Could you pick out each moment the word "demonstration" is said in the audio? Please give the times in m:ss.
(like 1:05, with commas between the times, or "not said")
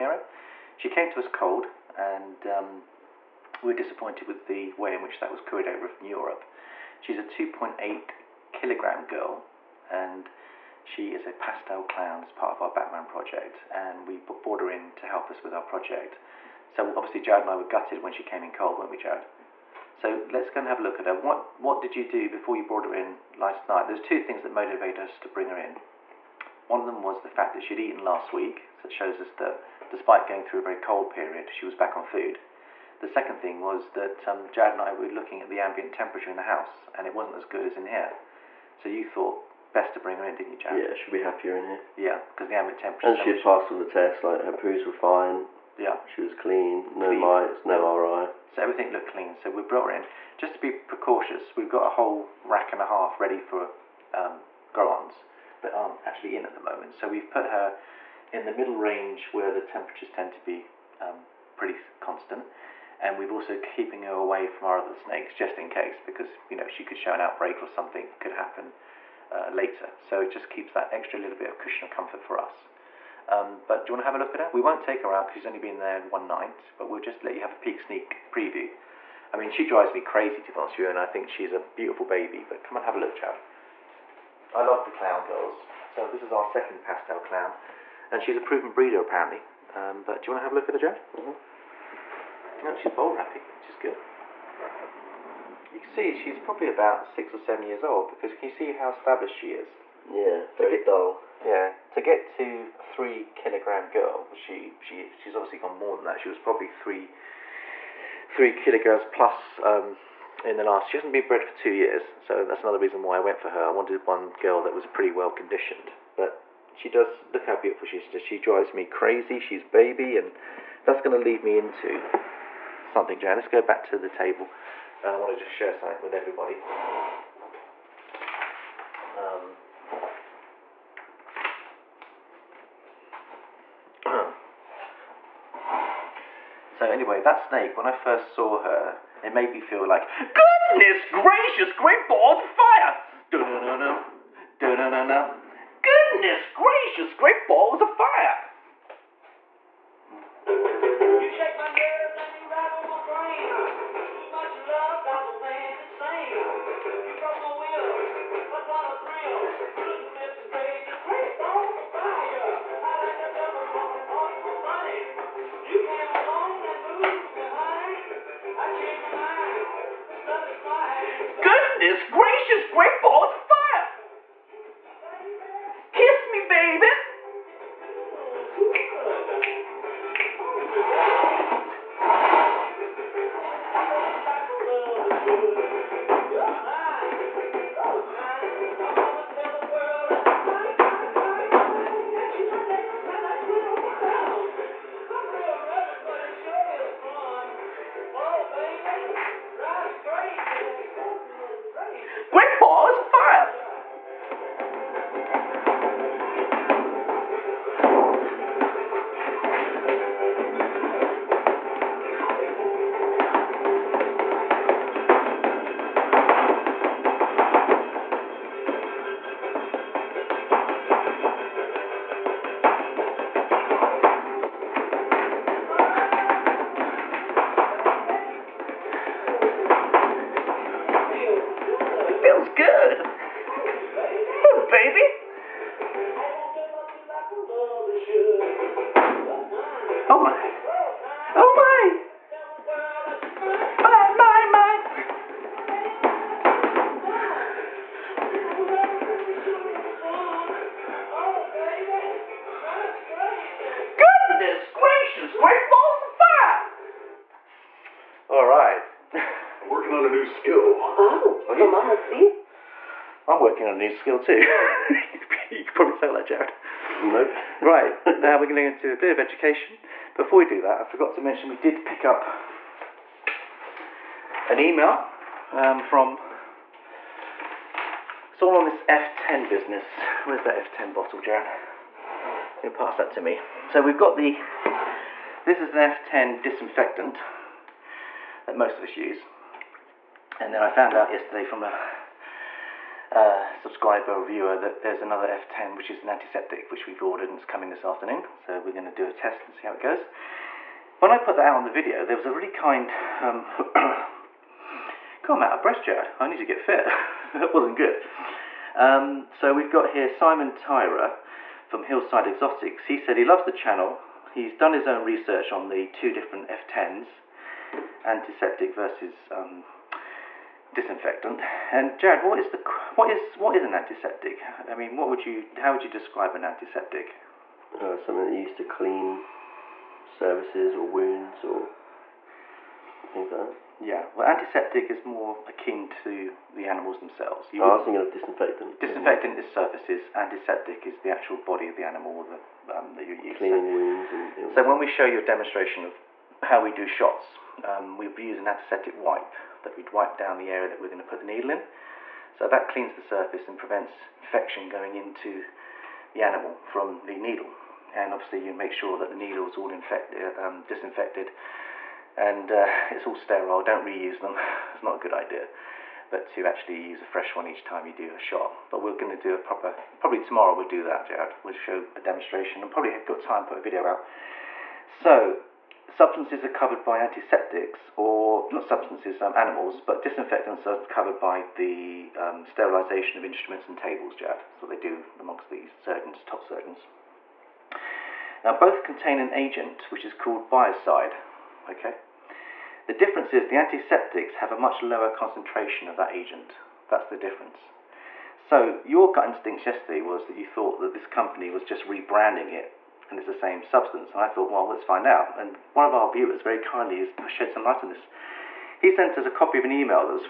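5:45, 6:11.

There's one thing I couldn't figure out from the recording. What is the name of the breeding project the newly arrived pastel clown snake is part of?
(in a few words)
Batman project.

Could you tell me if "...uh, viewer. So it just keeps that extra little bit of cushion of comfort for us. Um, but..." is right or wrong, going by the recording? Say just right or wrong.
wrong.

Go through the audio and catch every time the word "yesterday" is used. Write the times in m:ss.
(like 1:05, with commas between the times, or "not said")
4:51, 6:39.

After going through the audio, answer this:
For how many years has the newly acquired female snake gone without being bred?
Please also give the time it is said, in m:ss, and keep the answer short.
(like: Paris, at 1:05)
2 years, at 1:51.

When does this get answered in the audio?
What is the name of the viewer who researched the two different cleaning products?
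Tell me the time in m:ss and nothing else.
5:10.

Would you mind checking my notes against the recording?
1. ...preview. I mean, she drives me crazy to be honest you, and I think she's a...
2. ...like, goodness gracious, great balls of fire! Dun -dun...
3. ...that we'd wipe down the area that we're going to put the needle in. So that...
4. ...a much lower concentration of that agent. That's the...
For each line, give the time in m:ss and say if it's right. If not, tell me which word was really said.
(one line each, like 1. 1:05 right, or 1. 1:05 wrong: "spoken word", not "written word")
1. 1:18 right
2. 2:19 right
3. 5:49 right
4. 6:34 right.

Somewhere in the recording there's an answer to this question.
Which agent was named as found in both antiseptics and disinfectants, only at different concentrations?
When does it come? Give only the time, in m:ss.
6:30.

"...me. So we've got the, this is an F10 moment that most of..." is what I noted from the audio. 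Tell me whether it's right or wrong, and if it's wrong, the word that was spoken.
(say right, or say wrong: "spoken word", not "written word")
wrong: "disinfectant", not "moment".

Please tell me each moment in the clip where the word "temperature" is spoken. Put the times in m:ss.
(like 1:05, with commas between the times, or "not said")
0:35, 0:42, 0:59.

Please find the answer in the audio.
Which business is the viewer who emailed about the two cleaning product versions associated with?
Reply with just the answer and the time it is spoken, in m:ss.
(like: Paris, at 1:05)
Hillside Exotics, at 5:11.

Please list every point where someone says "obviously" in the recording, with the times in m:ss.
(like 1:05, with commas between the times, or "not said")
0:16, 1:45, 5:58.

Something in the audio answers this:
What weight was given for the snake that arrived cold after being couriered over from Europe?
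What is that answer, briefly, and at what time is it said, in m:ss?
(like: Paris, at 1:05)
2.8 kilograms, at 0:07.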